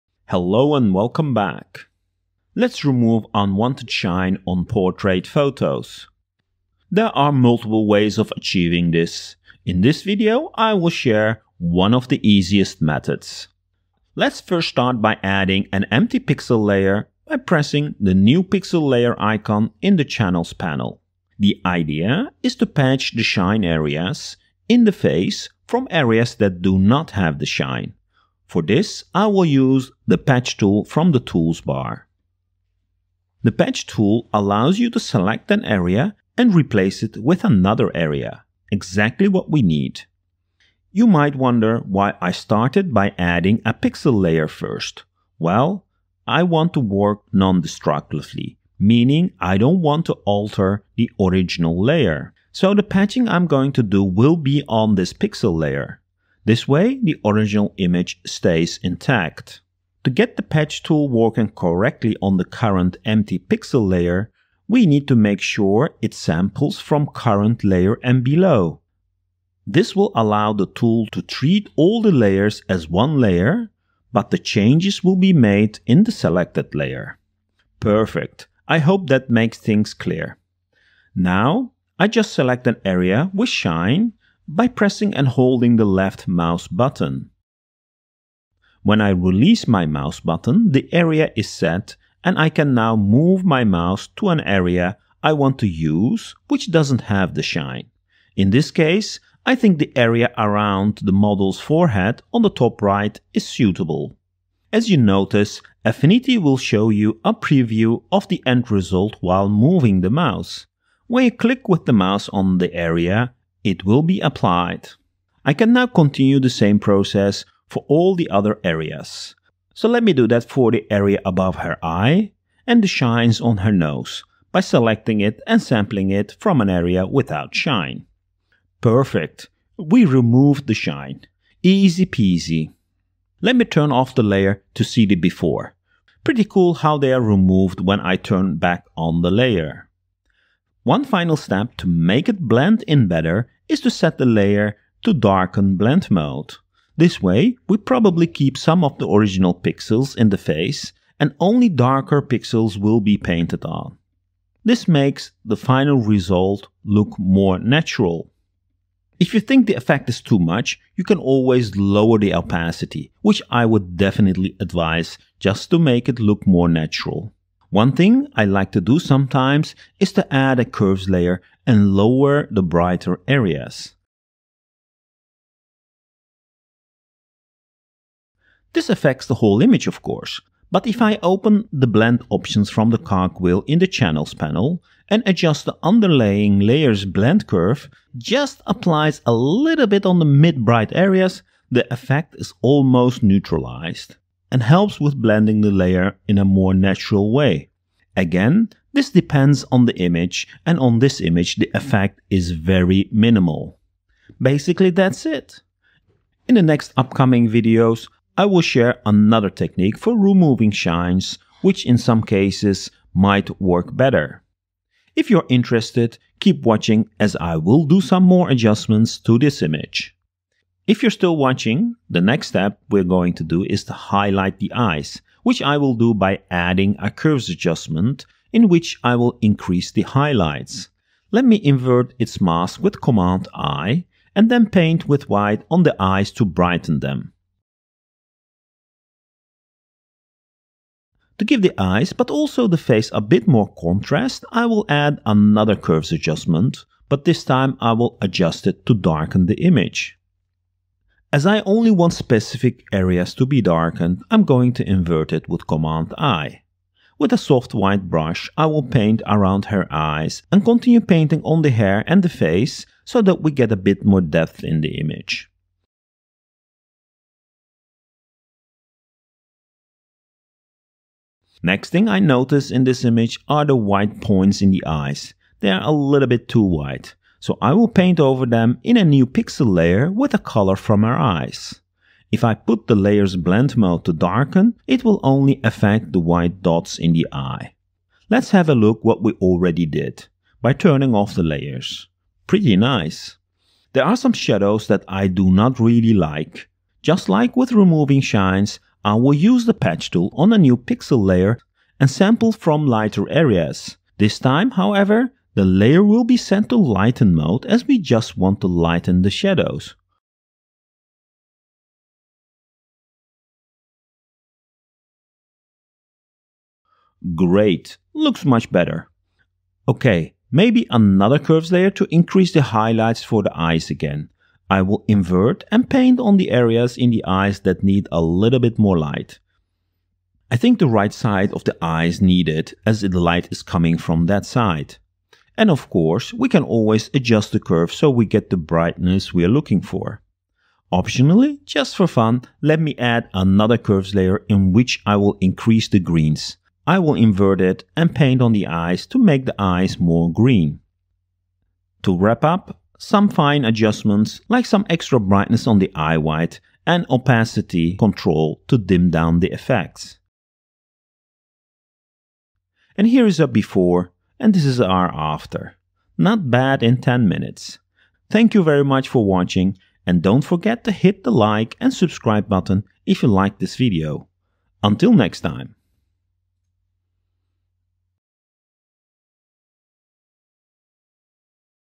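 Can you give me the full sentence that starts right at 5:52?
To wrap up, some fine adjustments like some extra brightness on the eye white and opacity control to dim down the effects.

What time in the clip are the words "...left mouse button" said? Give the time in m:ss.
1:25.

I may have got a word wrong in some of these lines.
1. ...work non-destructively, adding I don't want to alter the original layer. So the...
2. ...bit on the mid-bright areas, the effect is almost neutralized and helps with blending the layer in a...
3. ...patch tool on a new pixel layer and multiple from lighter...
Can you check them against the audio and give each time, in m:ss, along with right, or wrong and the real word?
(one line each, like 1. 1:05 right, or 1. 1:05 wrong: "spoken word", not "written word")
1. 0:46 wrong: "meaning", not "adding"
2. 3:09 right
3. 4:59 wrong: "sample", not "multiple".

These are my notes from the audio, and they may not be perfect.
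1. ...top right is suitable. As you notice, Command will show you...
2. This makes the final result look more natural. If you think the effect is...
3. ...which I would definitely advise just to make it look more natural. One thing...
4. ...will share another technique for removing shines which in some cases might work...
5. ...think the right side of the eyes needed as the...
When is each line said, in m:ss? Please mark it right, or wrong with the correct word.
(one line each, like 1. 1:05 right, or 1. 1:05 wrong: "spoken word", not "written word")
1. 1:42 wrong: "Affinity", not "Command"
2. 2:34 right
3. 2:43 right
4. 3:28 right
5. 5:30 right.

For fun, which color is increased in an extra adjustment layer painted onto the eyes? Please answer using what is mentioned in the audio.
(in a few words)
green.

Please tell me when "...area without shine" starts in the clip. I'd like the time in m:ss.
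2:06.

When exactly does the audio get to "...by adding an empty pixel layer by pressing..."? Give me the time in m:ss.
0:15.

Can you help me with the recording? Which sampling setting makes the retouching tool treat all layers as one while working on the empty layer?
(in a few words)
current layer and below.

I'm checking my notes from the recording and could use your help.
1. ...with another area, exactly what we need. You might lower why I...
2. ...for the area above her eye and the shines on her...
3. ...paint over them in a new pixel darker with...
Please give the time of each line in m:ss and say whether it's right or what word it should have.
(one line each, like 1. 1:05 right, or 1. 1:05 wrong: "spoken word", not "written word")
1. 0:37 wrong: "wonder", not "lower"
2. 2:00 right
3. 4:37 wrong: "layer", not "darker".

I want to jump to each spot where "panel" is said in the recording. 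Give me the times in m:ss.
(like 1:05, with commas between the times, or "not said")
0:20, 3:04.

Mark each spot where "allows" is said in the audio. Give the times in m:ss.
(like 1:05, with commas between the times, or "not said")
0:34, 1:10.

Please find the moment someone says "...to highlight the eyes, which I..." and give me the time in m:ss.
3:43.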